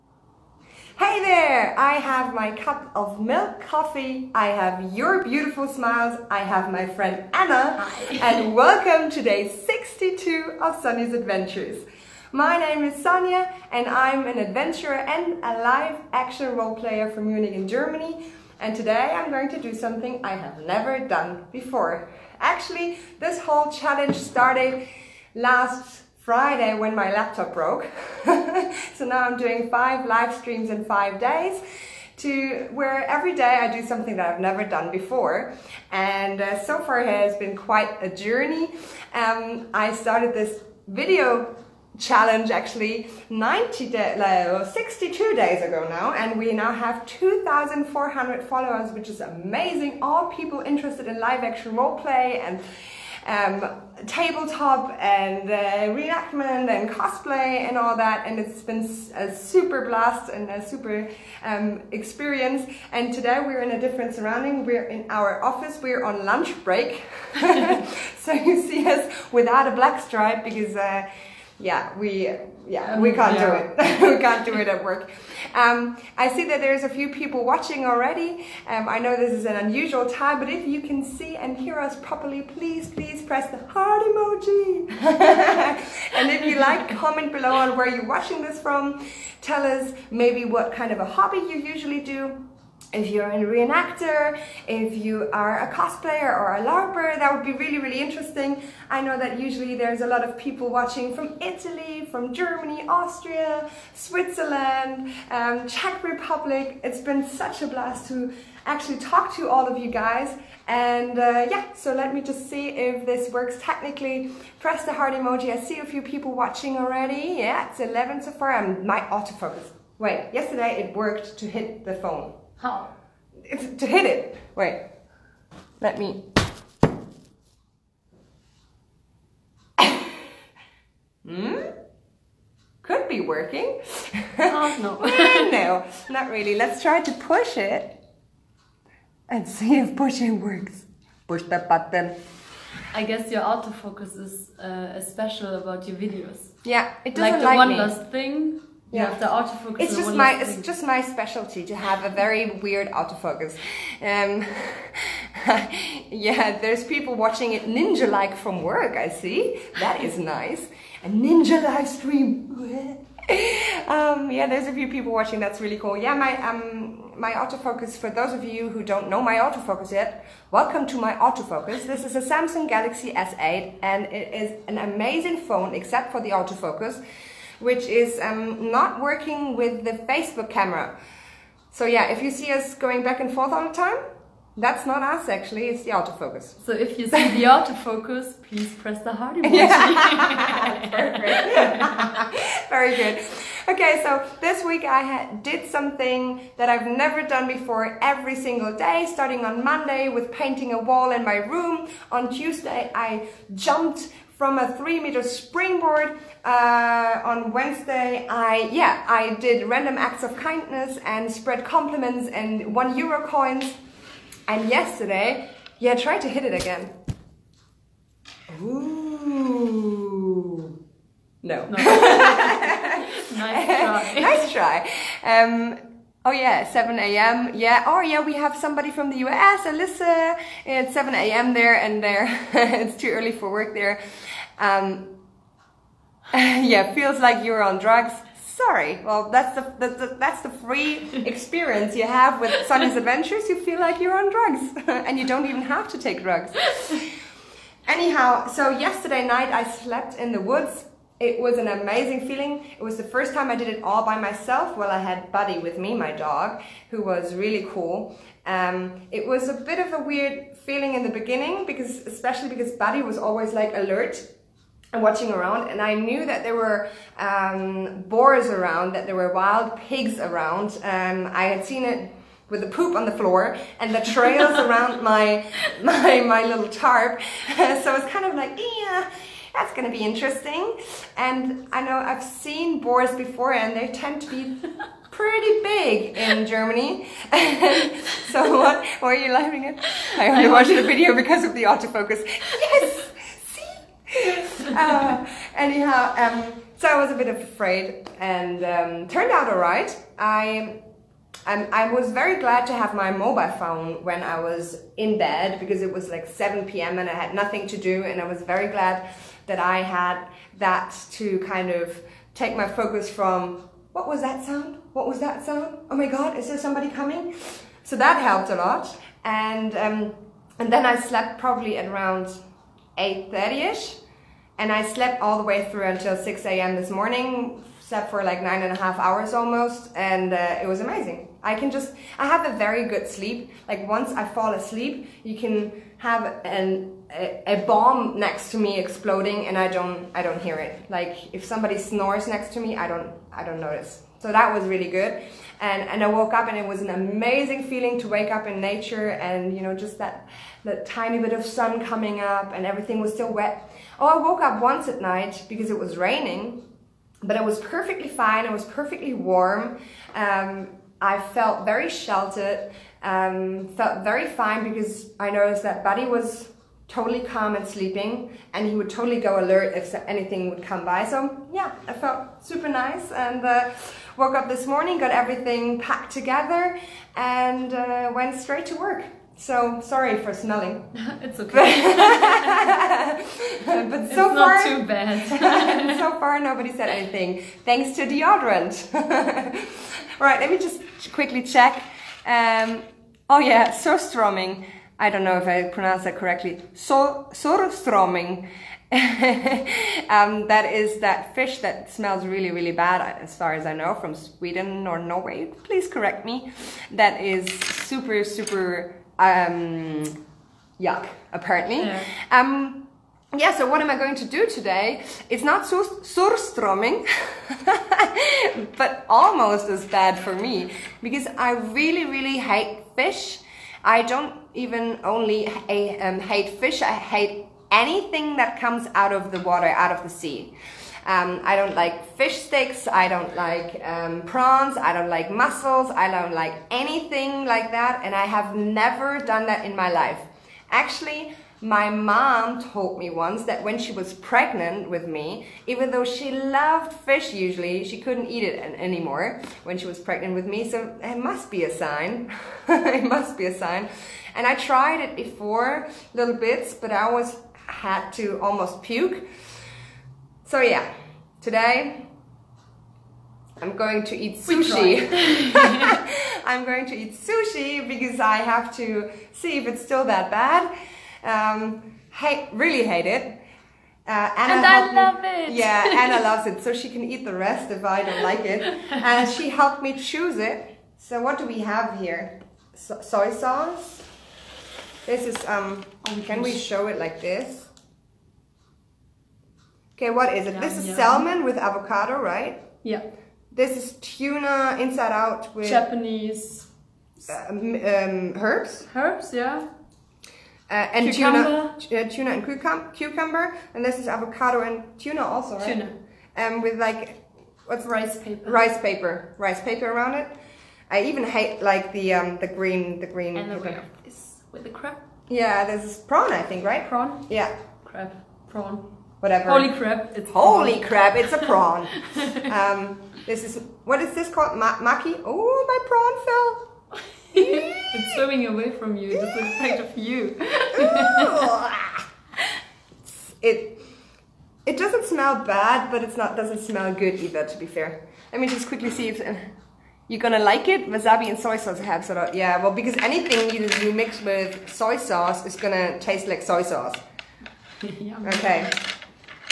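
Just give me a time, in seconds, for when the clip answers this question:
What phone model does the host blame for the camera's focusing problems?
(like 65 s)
172 s.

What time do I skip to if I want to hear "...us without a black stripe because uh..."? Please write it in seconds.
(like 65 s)
68 s.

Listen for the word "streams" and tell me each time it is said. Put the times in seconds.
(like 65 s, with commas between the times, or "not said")
30 s, 161 s.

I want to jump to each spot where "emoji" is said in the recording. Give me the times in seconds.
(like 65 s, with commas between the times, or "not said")
84 s, 115 s, 189 s.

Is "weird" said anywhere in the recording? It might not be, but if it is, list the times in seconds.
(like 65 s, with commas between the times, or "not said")
152 s, 260 s.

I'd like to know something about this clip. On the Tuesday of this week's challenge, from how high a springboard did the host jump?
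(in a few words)
3 meters.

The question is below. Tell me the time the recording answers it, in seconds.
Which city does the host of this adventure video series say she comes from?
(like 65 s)
17 s.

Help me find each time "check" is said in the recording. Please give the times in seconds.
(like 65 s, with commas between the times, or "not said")
391 s.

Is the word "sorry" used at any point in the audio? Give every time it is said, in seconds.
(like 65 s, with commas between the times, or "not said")
238 s, 379 s.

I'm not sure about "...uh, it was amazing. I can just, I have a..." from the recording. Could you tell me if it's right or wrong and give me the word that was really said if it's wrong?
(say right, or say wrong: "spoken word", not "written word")
right.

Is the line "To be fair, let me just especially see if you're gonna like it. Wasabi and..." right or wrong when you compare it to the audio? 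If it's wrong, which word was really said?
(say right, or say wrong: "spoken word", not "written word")
wrong: "quickly", not "especially".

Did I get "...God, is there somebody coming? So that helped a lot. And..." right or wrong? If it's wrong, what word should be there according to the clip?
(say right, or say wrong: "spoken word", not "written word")
right.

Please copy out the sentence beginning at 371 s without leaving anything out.
So yeah, I felt super nice and.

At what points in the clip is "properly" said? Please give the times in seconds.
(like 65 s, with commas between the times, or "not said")
81 s.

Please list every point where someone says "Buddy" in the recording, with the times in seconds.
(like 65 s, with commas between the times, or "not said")
255 s, 262 s, 365 s.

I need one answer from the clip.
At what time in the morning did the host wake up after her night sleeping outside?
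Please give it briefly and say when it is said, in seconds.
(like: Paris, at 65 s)
6 a.m., at 326 s.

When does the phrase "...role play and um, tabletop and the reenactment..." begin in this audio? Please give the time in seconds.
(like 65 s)
51 s.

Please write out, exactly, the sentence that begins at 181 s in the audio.
So yeah, if you see us going back and forth all the time, that's not us actually, it's the autofocus.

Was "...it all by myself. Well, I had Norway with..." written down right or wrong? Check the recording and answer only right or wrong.
wrong.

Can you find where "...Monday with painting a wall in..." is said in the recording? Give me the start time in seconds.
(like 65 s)
199 s.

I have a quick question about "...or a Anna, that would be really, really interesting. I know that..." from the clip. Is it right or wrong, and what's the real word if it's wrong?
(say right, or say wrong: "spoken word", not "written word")
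wrong: "LARPer", not "Anna".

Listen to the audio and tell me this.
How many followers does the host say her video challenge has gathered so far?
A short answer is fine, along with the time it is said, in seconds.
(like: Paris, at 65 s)
2,400, at 47 s.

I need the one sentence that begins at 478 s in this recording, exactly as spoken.
And she helped me choose it.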